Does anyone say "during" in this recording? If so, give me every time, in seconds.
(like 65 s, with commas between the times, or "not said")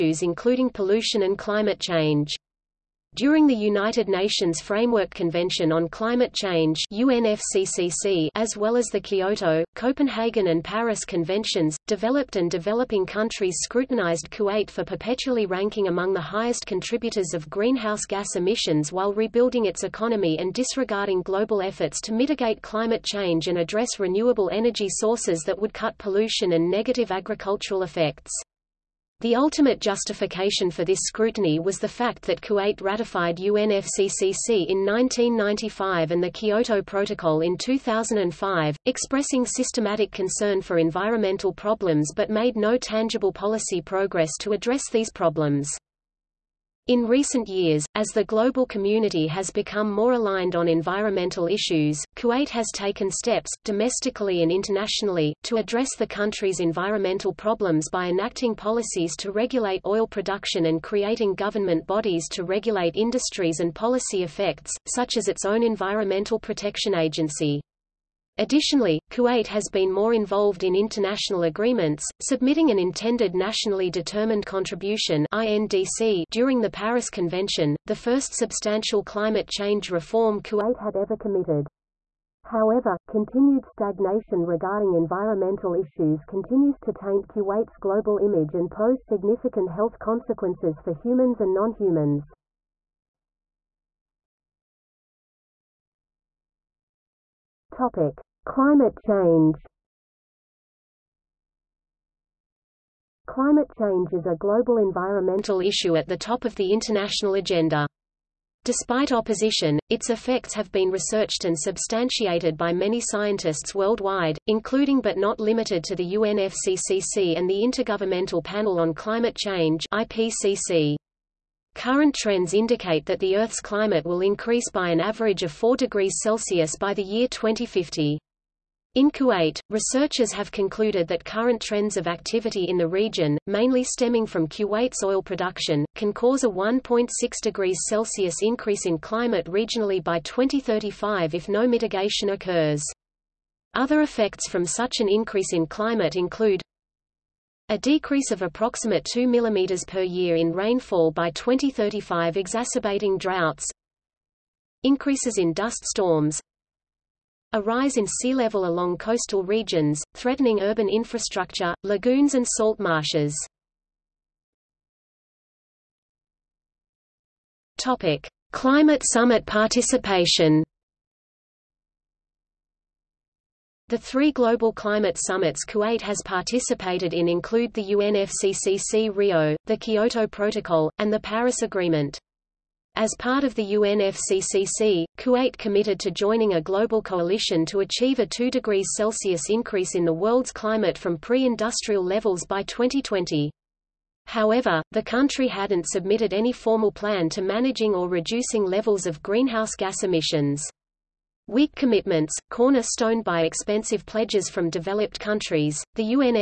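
3 s, 76 s.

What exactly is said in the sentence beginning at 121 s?
Current trends indicate that the Earth's climate will increase by an average of 4 degrees Celsius by the year 2050.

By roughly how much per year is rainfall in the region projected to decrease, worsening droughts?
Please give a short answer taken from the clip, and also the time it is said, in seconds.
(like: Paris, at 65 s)
2 mm, at 149 s.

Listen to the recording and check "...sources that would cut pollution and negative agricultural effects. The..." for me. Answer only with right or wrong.
right.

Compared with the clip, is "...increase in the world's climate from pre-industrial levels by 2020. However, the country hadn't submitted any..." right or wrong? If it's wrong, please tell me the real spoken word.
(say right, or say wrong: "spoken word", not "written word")
right.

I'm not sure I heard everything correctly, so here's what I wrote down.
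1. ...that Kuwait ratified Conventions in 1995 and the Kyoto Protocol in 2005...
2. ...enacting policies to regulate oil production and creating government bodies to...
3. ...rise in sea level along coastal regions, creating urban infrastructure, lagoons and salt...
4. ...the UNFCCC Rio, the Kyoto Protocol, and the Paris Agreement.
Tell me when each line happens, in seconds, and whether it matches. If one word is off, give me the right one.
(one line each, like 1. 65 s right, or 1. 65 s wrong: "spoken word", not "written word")
1. 32 s wrong: "UNFCCC", not "Conventions"
2. 58 s right
3. 157 s wrong: "threatening", not "creating"
4. 177 s right.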